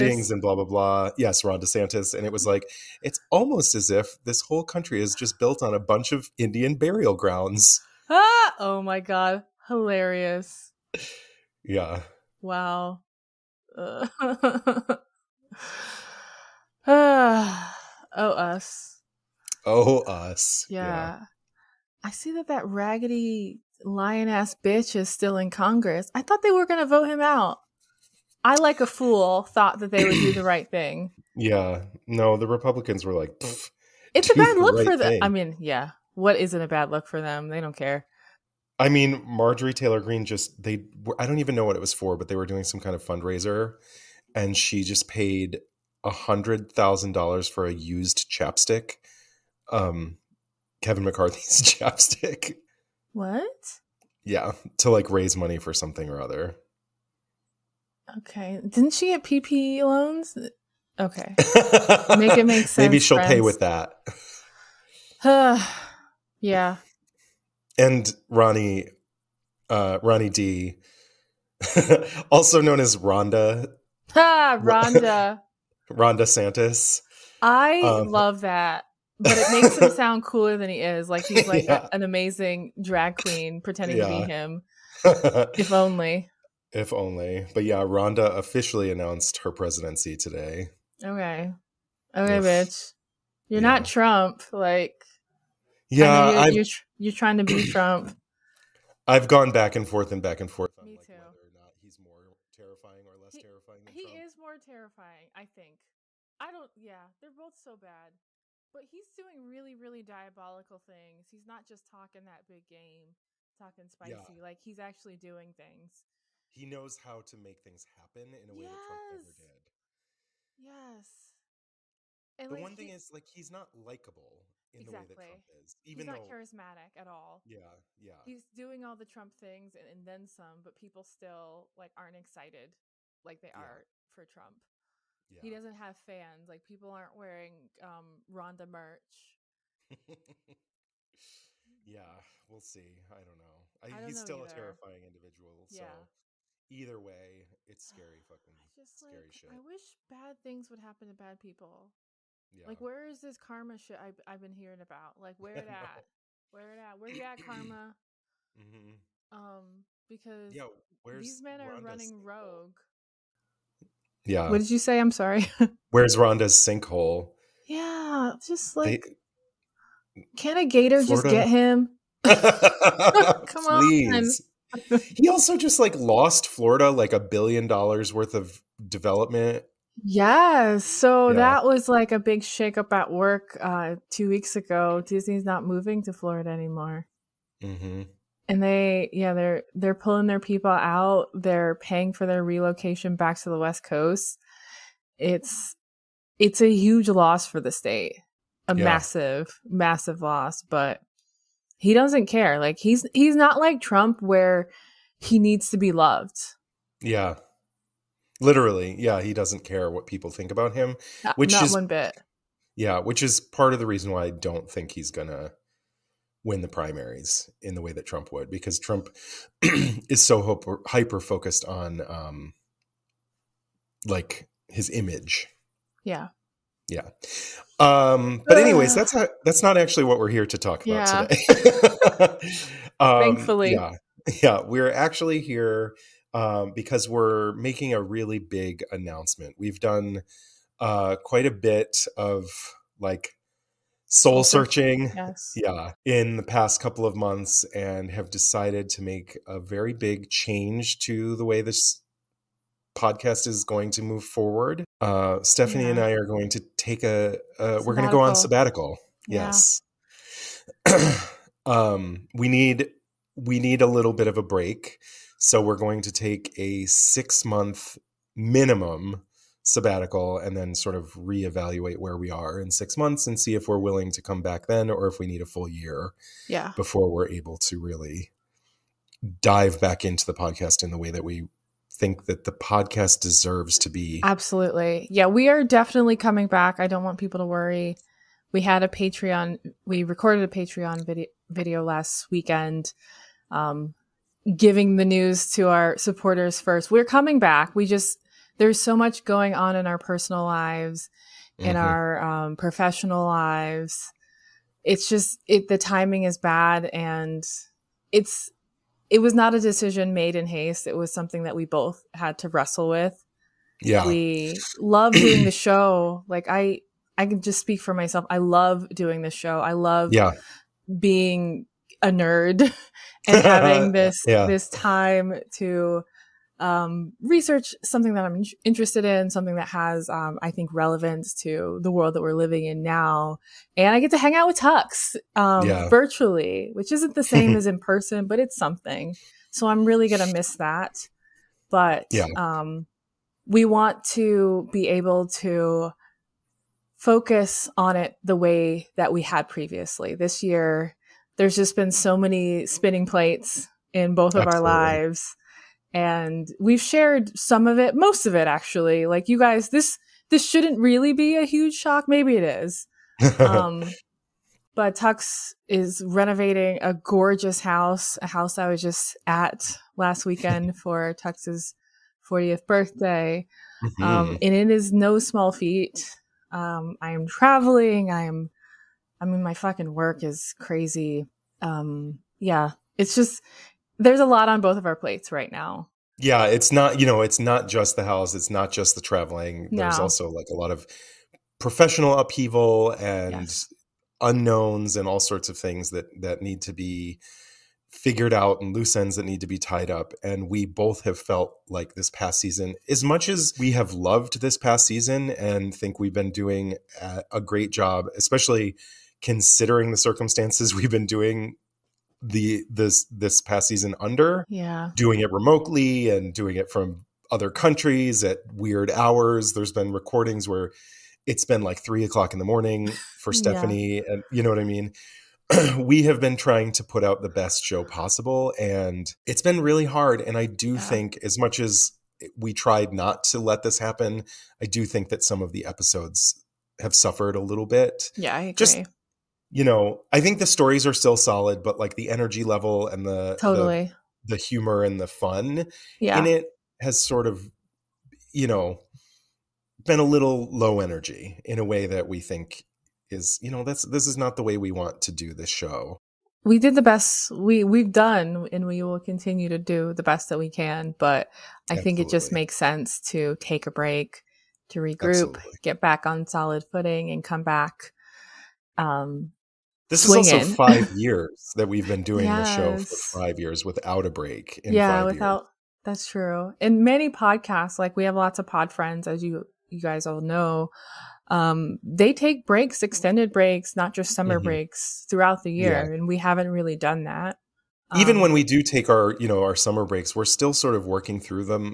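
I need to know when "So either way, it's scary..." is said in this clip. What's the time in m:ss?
2:26.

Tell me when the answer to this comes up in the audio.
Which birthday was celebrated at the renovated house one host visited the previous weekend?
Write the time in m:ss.
6:12.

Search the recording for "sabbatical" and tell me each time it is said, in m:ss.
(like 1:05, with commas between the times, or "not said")
4:18, 4:29.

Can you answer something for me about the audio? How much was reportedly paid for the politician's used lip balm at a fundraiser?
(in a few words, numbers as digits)
$100,000.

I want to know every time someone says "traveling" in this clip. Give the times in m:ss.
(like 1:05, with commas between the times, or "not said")
6:17, 6:29.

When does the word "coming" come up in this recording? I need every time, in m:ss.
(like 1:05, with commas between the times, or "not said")
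4:46, 4:57.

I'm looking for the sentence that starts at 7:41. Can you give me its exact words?
think it just makes sense to take a break, to regroup, Absolutely.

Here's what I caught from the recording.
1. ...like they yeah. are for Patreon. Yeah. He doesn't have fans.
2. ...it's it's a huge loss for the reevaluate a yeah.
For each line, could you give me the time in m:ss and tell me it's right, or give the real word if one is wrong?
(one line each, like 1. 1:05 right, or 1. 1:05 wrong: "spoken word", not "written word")
1. 2:13 wrong: "Trump", not "Patreon"
2. 3:15 wrong: "state", not "reevaluate".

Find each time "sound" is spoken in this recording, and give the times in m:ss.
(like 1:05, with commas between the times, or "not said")
1:19.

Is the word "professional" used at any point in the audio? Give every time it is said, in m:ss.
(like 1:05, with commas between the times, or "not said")
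5:02, 6:31.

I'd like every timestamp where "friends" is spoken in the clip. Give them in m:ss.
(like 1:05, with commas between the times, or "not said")
1:03, 7:58.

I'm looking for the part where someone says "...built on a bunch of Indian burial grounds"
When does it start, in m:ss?
0:05.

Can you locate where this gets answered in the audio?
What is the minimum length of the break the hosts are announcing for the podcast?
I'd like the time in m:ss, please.
4:26.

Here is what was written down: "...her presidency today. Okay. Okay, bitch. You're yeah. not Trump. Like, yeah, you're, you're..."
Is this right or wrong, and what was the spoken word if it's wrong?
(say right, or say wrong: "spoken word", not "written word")
right.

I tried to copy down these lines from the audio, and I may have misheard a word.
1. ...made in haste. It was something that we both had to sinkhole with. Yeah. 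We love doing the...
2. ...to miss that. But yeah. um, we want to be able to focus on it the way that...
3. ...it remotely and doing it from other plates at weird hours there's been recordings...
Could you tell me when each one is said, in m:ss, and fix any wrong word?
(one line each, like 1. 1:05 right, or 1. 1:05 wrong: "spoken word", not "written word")
1. 5:10 wrong: "wrestle", not "sinkhole"
2. 5:40 right
3. 6:55 wrong: "countries", not "plates".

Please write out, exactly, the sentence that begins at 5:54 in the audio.
our lives and we've shared some of it, most of it actually.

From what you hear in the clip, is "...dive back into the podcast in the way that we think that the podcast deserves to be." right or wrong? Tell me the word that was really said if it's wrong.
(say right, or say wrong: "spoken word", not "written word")
right.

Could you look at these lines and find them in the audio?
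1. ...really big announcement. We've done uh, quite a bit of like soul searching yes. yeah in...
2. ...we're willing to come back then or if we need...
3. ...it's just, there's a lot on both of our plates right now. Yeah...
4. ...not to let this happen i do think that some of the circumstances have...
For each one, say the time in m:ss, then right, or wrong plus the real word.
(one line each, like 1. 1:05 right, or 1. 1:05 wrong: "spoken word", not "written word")
1. 3:58 right
2. 4:33 right
3. 6:22 right
4. 7:12 wrong: "episodes", not "circumstances".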